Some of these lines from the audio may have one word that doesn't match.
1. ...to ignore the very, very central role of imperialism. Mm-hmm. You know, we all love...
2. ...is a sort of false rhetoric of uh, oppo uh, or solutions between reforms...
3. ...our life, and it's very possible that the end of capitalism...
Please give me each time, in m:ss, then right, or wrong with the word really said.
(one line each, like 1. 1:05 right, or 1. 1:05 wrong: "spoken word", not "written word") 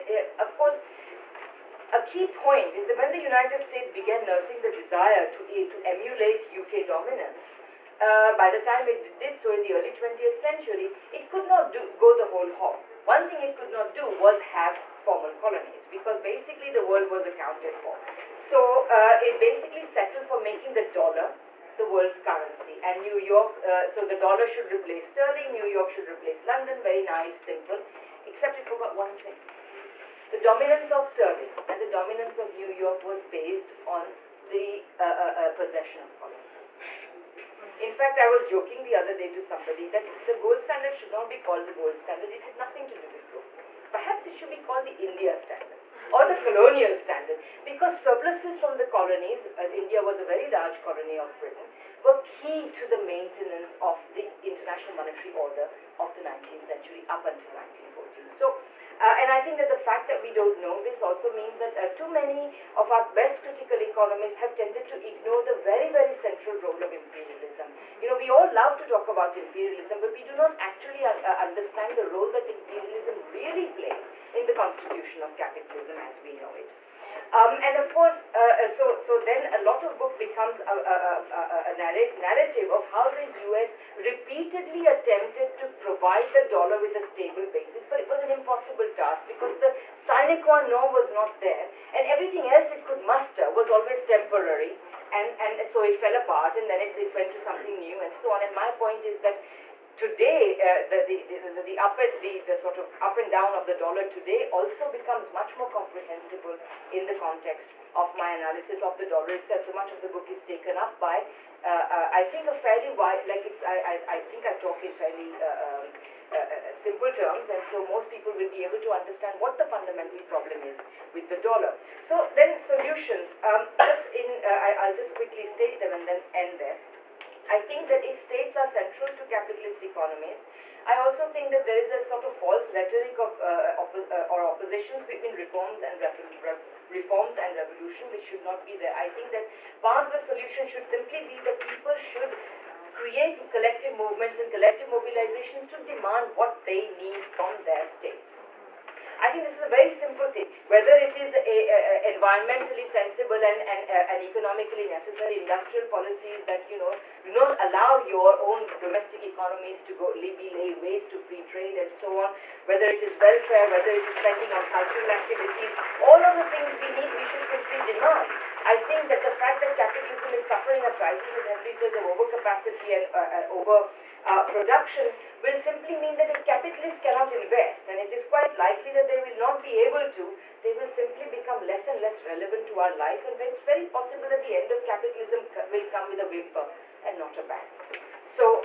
1. 1:04 right
2. 2:11 wrong: "oppositions", not "solutions"
3. 3:02 right.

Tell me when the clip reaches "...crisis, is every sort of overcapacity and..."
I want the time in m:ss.
2:50.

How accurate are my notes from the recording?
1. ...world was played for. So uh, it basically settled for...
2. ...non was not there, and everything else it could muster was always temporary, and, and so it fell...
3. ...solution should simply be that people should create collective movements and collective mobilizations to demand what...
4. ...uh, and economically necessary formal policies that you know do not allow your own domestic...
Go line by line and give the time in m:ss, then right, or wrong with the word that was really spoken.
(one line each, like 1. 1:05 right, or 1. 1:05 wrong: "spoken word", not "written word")
1. 0:16 wrong: "accounted", not "played"
2. 1:30 right
3. 2:20 right
4. 2:33 wrong: "industrial", not "formal".